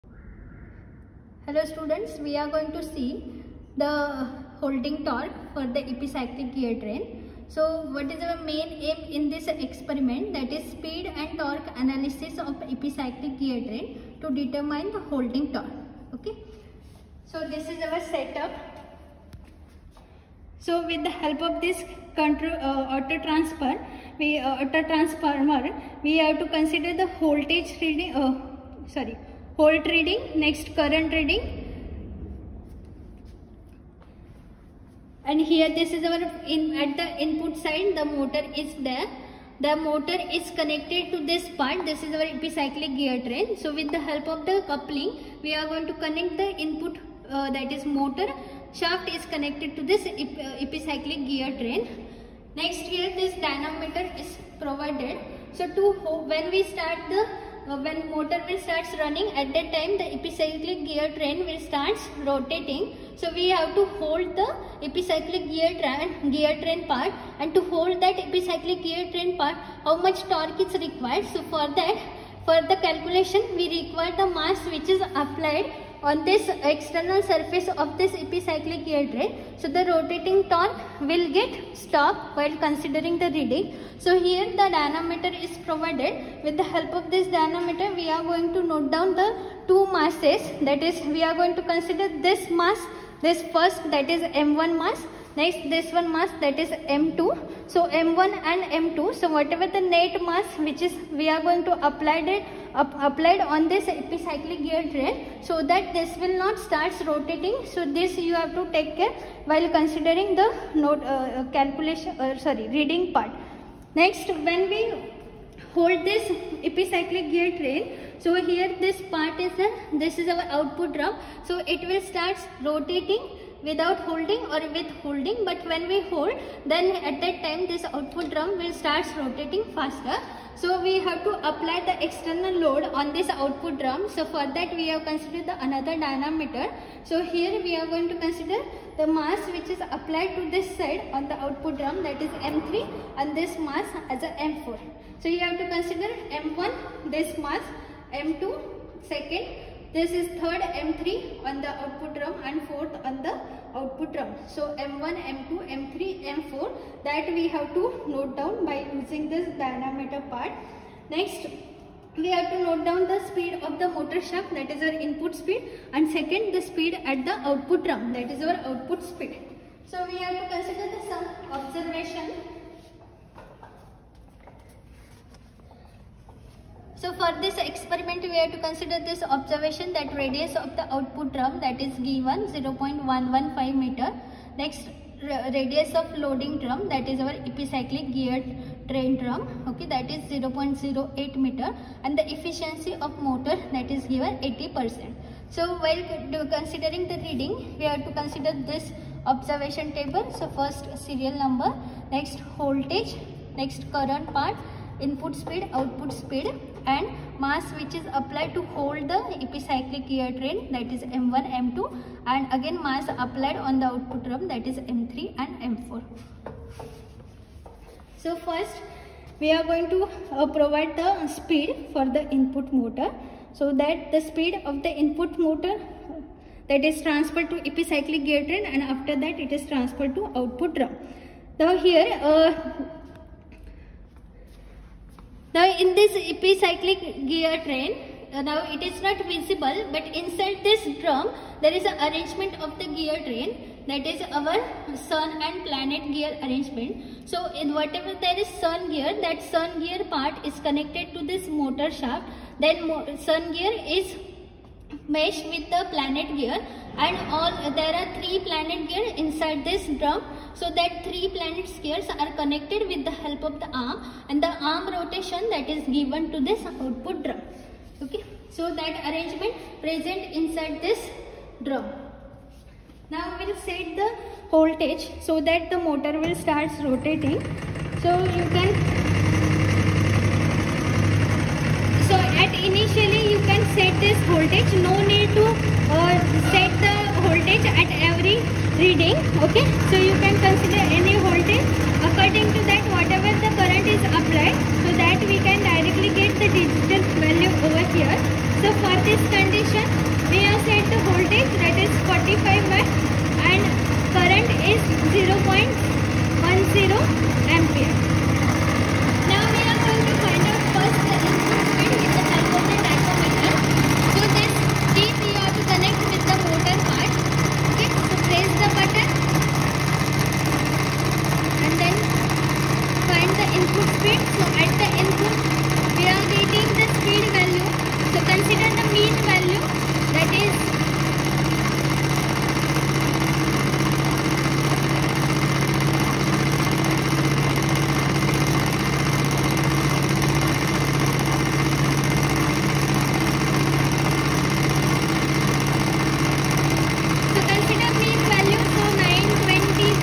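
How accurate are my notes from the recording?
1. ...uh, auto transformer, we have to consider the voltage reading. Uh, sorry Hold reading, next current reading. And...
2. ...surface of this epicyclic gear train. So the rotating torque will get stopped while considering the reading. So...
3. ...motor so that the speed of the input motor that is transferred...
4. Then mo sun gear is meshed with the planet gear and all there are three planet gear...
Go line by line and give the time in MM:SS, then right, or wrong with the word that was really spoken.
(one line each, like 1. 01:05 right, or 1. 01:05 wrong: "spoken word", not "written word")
1. 00:24 right
2. 01:17 right
3. 03:42 right
4. 04:12 right.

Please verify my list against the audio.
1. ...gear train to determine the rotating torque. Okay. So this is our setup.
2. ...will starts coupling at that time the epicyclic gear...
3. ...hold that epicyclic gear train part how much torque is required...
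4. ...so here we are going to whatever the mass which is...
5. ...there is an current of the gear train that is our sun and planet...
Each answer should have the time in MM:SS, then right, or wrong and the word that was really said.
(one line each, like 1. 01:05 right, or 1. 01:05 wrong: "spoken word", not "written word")
1. 00:13 wrong: "holding", not "rotating"
2. 00:58 wrong: "running", not "coupling"
3. 01:07 right
4. 02:17 wrong: "consider", not "whatever"
5. 04:01 wrong: "arrangement", not "current".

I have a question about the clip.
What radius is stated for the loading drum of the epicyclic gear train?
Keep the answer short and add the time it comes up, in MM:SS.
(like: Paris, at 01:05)
0.08 m, at 03:10.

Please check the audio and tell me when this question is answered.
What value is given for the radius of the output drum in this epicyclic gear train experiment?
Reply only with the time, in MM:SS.
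03:02.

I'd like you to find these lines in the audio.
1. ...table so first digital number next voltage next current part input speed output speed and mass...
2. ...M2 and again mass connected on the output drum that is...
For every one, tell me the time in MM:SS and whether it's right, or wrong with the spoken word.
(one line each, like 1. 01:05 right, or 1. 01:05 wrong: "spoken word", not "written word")
1. 03:19 wrong: "serial", not "digital"
2. 03:31 wrong: "applied", not "connected".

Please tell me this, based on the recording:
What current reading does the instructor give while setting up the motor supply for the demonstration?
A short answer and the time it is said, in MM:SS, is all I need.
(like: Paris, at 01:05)
0.6, at 05:05.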